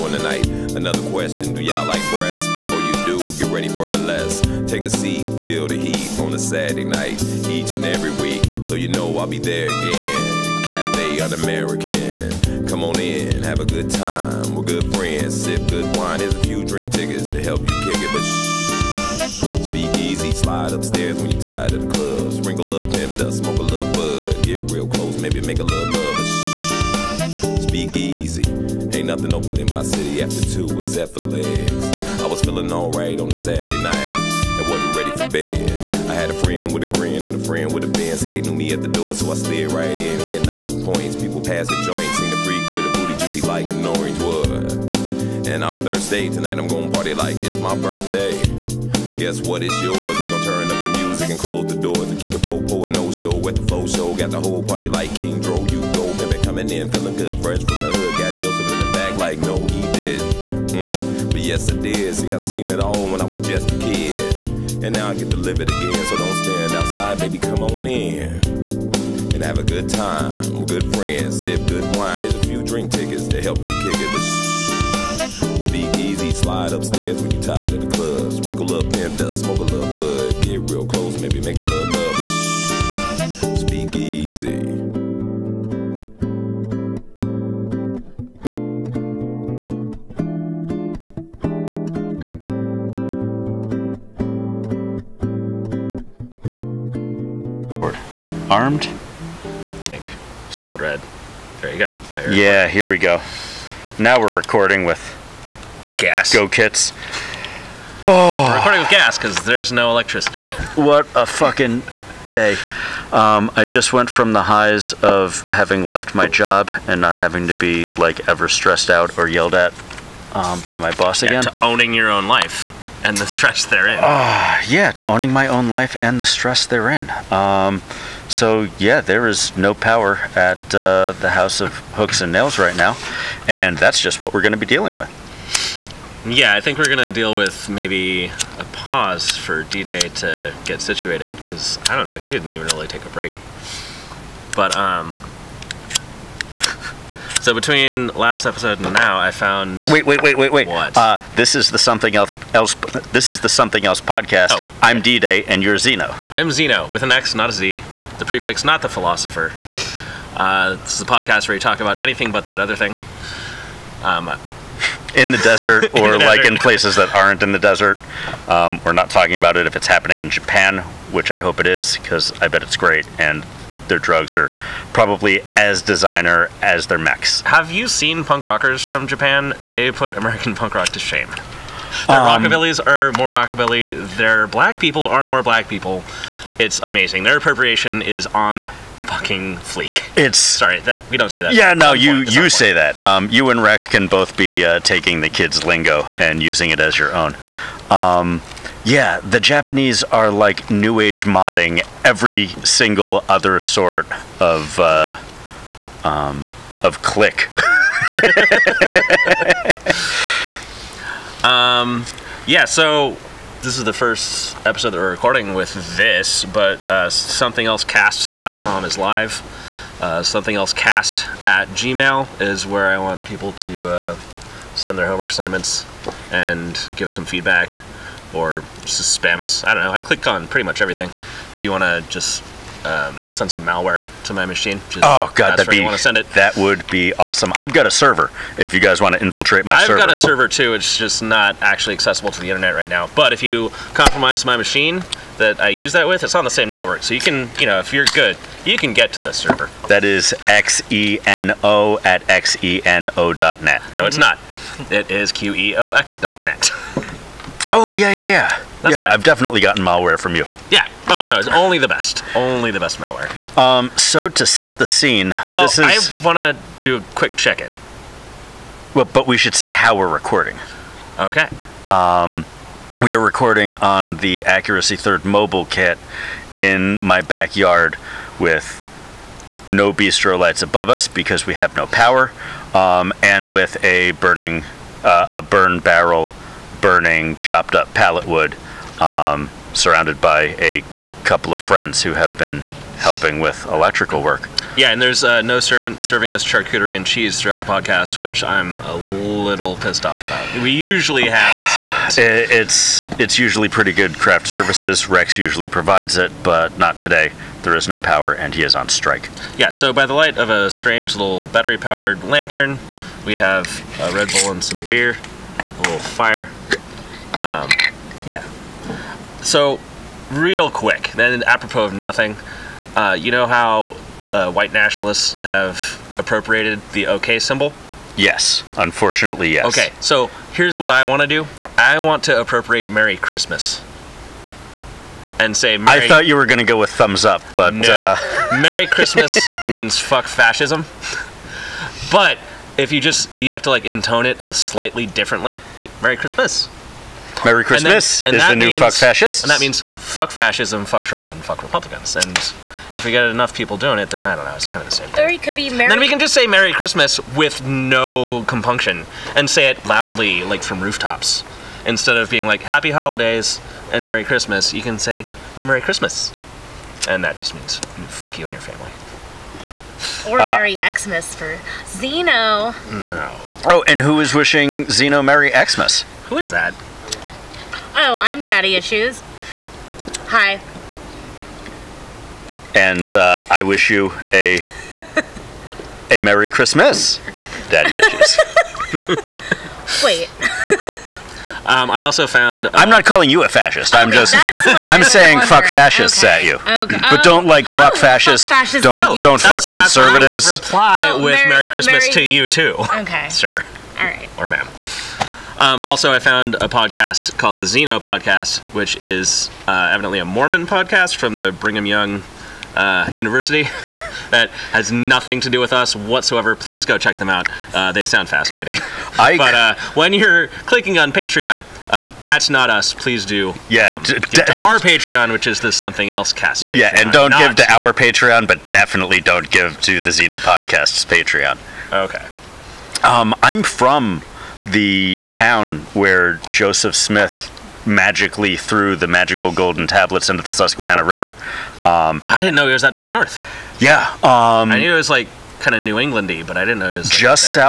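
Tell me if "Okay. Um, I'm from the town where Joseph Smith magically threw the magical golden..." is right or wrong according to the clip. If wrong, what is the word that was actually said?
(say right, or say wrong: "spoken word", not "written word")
right.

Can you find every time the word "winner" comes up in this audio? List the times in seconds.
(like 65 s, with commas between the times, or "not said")
not said.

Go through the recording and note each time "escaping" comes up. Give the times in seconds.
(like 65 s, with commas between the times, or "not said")
not said.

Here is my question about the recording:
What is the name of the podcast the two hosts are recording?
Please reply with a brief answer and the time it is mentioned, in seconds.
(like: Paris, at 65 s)
The Something Else Podcast, at 153 s.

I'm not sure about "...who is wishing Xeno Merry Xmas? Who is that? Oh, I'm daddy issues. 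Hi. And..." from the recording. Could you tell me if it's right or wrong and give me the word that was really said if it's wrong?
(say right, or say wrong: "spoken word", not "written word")
right.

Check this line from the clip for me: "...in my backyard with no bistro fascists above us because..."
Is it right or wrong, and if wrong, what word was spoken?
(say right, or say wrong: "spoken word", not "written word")
wrong: "lights", not "fascists".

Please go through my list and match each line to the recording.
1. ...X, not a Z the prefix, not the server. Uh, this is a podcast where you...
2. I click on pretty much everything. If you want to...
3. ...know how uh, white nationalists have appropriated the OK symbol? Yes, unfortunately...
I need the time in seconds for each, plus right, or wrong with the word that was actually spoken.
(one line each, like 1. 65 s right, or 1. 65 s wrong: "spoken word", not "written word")
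1. 157 s wrong: "philosopher", not "server"
2. 229 s right
3. 323 s right.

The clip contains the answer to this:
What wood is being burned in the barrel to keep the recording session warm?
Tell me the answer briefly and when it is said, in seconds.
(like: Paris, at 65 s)
chopped up pallet wood, at 287 s.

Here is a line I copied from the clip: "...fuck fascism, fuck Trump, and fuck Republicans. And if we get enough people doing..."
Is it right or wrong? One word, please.
right.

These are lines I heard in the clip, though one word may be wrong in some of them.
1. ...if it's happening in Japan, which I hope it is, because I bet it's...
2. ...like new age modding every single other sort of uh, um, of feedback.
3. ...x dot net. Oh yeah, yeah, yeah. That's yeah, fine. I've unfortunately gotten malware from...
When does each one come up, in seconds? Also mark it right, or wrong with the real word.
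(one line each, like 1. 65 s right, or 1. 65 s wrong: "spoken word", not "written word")
1. 169 s right
2. 200 s wrong: "click", not "feedback"
3. 255 s wrong: "definitely", not "unfortunately".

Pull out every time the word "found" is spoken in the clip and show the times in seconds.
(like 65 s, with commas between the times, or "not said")
149 s, 392 s, 406 s.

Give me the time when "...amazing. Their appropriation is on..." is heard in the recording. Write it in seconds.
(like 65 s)
186 s.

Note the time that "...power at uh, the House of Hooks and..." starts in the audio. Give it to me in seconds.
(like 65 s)
129 s.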